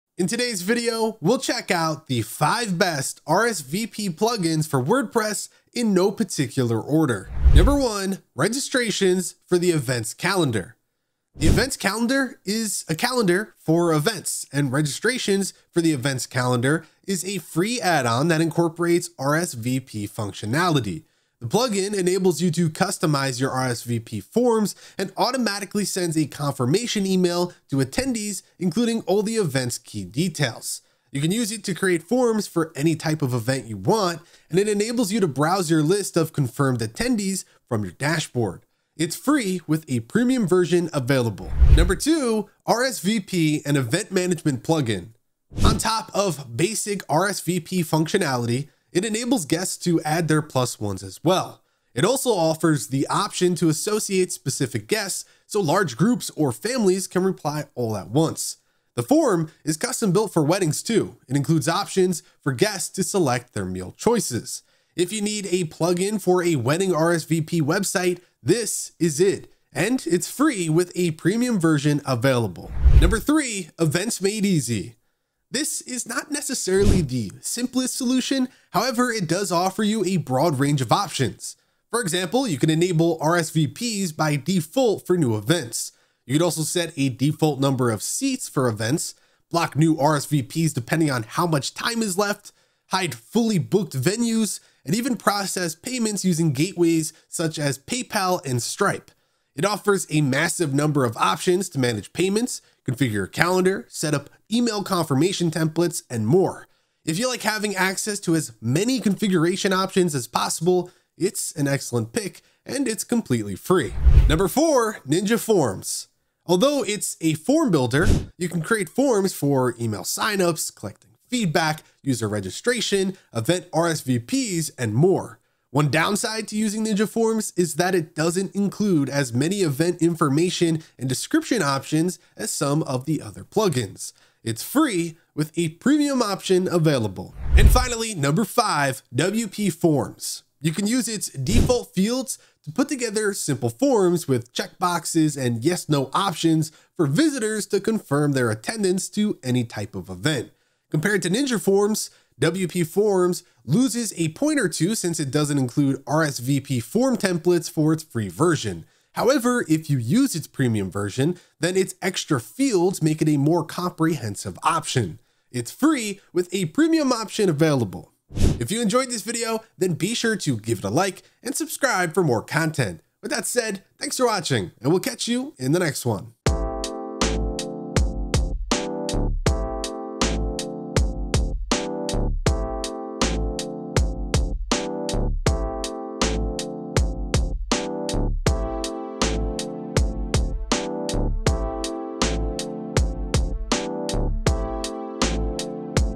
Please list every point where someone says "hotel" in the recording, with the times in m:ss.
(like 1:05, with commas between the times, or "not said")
not said.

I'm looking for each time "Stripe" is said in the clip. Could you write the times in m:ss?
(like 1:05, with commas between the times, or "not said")
1:38.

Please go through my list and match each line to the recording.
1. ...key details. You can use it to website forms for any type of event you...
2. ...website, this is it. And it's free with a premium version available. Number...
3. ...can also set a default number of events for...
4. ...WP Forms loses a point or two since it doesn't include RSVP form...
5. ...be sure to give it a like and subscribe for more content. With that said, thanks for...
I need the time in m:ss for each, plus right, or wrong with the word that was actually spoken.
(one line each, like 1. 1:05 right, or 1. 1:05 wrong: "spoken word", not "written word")
1. 0:29 wrong: "create", not "website"
2. 1:07 right
3. 1:26 wrong: "seats", not "events"
4. 2:32 right
5. 2:49 right.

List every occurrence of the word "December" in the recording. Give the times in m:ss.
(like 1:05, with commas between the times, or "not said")
not said.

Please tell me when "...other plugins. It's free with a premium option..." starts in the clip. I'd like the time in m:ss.
2:13.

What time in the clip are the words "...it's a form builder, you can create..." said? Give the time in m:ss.
1:56.